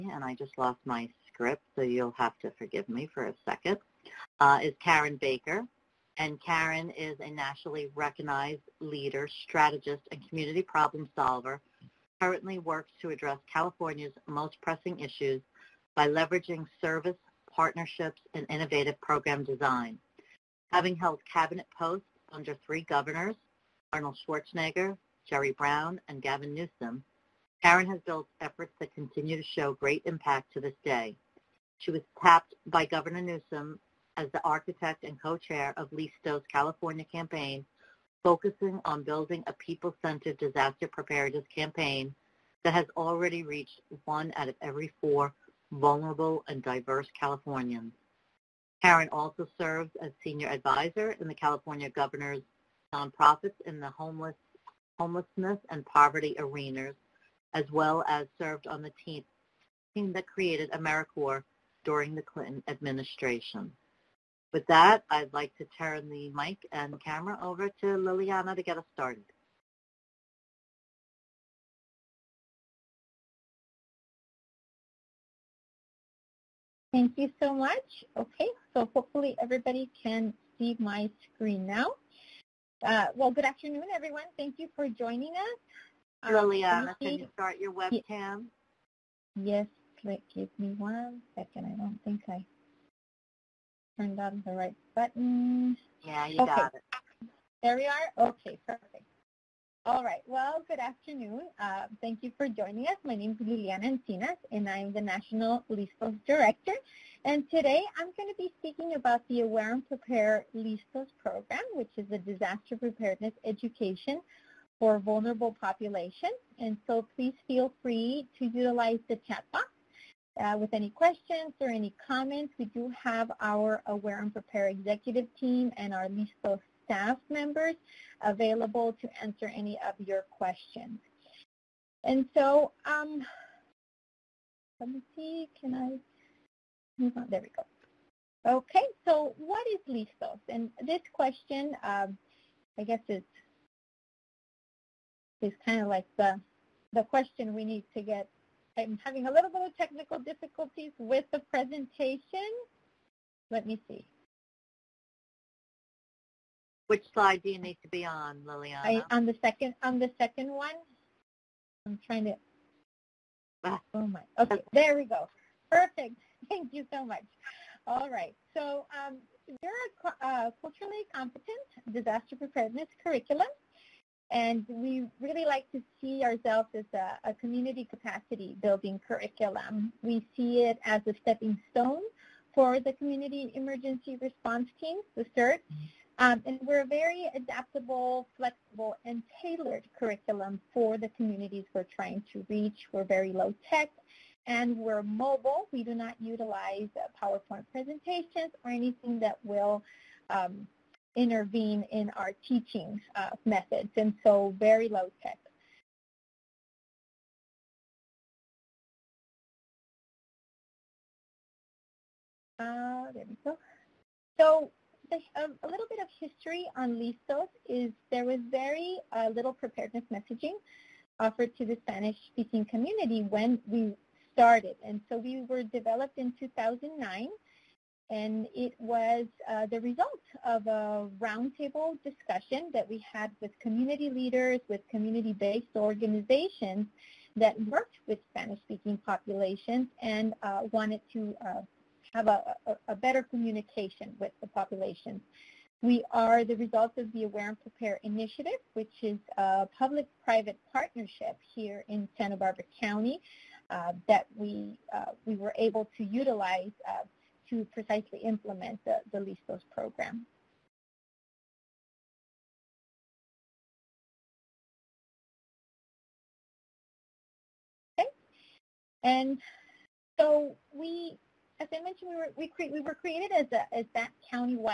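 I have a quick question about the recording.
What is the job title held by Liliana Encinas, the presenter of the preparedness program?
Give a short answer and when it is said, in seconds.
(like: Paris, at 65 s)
National LISTOS Director, at 105 s.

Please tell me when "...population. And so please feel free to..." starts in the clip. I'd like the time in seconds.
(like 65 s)
115 s.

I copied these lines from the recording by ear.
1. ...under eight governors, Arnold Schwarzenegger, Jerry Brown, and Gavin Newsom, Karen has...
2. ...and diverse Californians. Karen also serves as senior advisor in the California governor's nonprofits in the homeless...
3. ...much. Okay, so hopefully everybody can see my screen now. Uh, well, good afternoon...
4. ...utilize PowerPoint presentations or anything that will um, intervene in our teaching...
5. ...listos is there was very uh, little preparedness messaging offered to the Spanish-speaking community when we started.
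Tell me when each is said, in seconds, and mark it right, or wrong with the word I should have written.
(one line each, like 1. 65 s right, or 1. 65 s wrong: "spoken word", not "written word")
1. 22 s wrong: "three", not "eight"
2. 46 s right
3. 77 s right
4. 196 s right
5. 216 s right.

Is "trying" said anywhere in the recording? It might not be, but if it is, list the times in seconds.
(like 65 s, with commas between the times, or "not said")
162 s, 191 s.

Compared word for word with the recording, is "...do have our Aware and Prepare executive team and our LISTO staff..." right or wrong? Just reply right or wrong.
right.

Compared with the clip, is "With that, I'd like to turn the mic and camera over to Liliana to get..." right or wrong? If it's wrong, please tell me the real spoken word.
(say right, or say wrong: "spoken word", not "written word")
right.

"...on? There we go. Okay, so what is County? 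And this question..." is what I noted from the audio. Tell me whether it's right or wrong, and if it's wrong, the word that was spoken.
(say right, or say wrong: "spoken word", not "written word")
wrong: "LISTOS", not "County".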